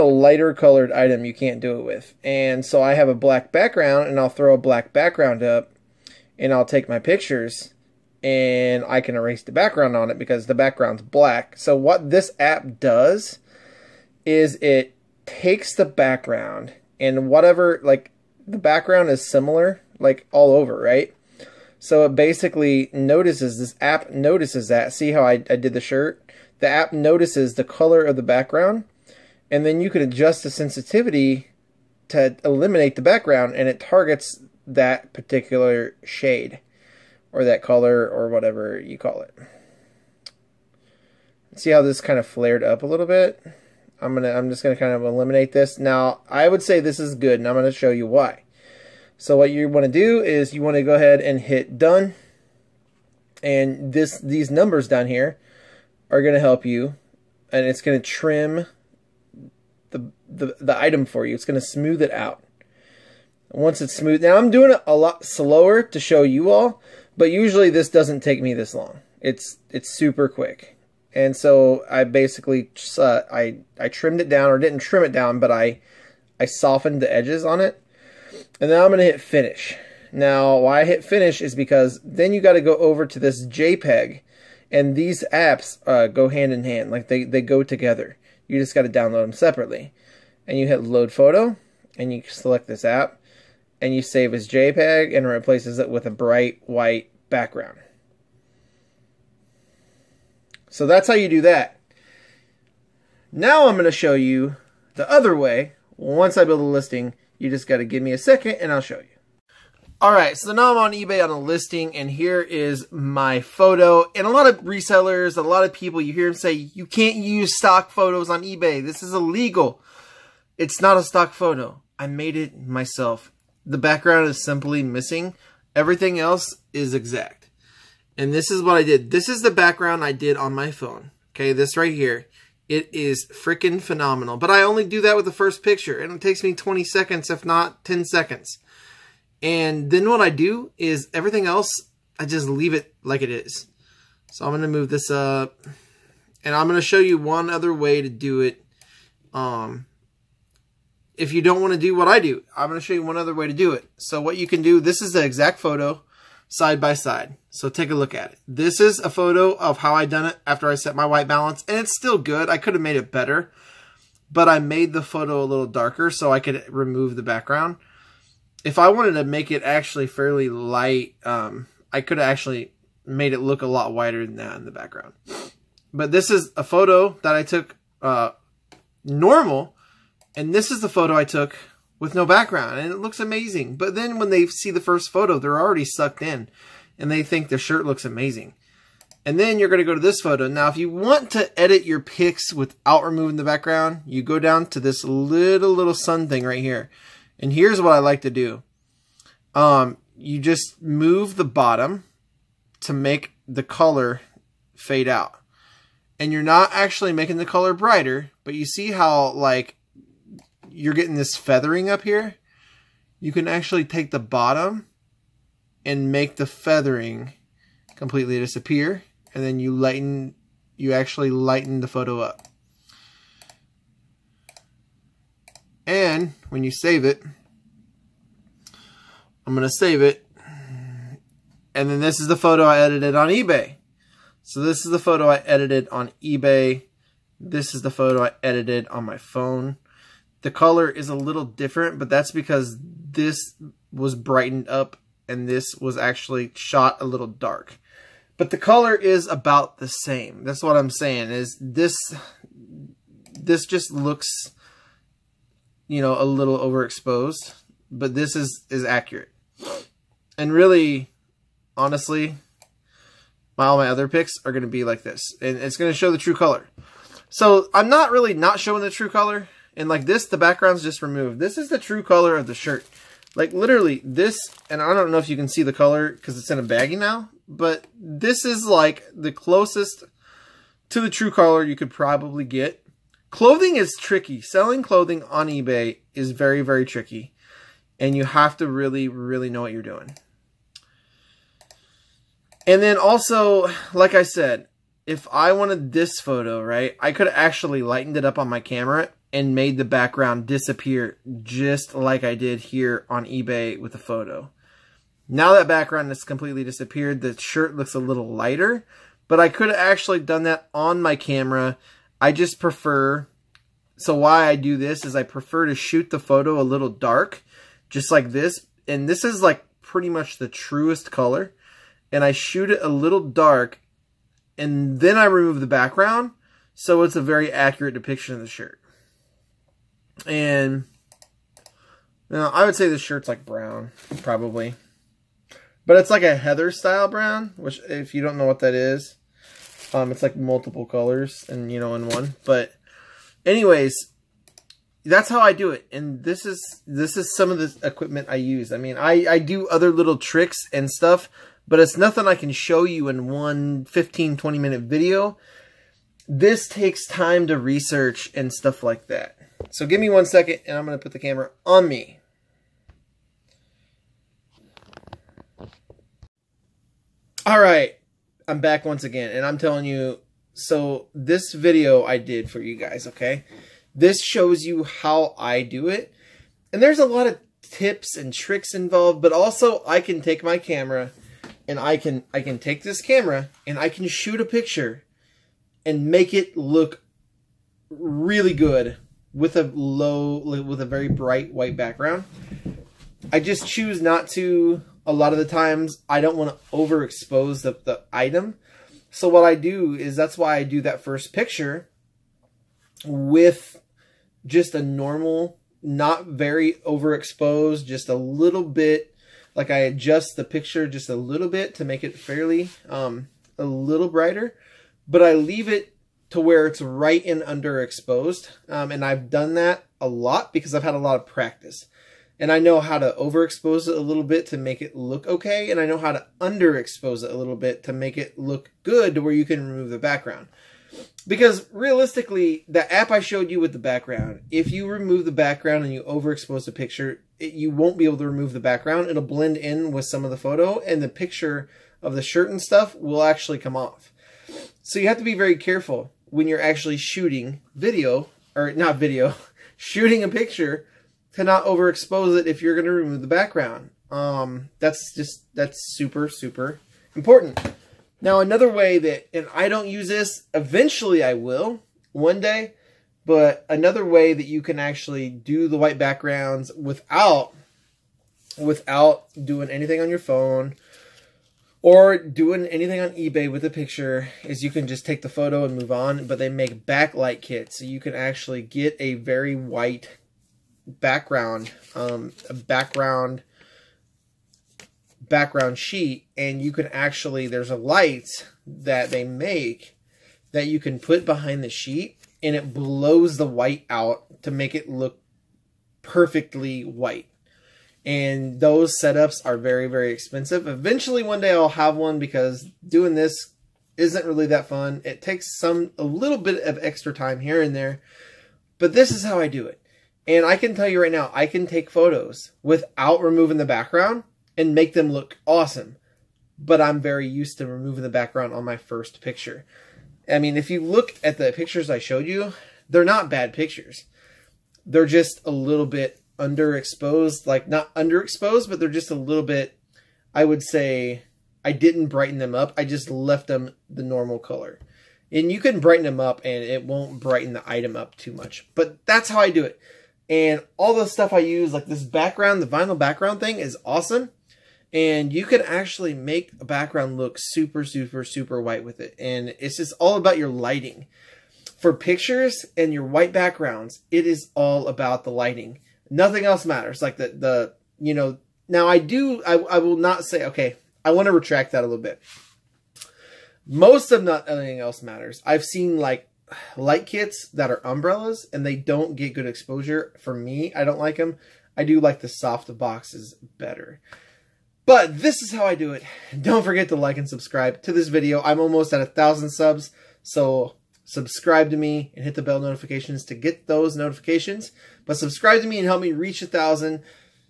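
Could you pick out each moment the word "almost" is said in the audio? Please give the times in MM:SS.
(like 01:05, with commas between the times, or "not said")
09:38.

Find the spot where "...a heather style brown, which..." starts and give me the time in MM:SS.
05:36.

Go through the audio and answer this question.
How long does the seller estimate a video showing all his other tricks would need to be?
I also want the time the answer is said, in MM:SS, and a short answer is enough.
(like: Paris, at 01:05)
15, 20 minutes, at 05:53.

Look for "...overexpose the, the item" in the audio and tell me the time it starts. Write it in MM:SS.
06:36.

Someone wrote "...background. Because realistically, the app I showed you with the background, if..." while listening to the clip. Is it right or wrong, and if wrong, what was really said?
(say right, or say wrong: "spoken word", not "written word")
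right.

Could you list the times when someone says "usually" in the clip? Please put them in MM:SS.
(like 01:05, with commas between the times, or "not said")
01:07.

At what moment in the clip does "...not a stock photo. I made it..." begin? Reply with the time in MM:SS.
02:00.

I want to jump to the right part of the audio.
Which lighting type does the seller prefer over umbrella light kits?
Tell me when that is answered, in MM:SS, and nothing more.
09:32.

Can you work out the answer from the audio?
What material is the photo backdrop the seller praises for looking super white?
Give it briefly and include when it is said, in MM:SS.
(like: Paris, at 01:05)
vinyl, at 09:02.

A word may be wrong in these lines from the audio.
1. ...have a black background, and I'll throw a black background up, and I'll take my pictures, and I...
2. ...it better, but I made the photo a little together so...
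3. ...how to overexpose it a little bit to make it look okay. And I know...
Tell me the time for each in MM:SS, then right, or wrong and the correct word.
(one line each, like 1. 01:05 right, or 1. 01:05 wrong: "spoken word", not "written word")
1. 00:02 right
2. 02:42 wrong: "darker", not "together"
3. 07:02 right.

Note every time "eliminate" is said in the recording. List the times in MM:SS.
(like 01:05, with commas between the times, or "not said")
00:32, 00:45.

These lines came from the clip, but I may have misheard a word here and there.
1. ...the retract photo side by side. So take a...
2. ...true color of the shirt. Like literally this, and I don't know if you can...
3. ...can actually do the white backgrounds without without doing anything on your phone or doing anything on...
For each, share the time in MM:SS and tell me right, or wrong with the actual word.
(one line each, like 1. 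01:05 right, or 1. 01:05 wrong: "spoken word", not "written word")
1. 02:35 wrong: "exact", not "retract"
2. 04:31 right
3. 07:44 right.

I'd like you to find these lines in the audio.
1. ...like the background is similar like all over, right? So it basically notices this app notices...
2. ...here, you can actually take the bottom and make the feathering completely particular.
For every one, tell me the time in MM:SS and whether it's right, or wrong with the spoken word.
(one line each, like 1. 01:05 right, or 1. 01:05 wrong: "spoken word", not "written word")
1. 00:17 right
2. 03:32 wrong: "disappear", not "particular".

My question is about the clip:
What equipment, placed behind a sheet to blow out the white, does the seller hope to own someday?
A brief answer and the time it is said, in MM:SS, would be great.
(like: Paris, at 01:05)
backlight kits, at 07:56.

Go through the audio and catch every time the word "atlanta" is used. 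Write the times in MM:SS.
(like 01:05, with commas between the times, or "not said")
not said.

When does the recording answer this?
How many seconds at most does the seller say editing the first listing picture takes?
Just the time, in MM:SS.
02:16.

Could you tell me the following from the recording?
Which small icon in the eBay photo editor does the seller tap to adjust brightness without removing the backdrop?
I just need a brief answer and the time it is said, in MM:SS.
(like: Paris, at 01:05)
little sun, at 03:15.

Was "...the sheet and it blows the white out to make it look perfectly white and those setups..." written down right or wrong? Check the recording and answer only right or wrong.
right.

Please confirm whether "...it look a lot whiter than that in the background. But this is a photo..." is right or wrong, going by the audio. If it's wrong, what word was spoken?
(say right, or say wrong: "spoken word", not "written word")
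right.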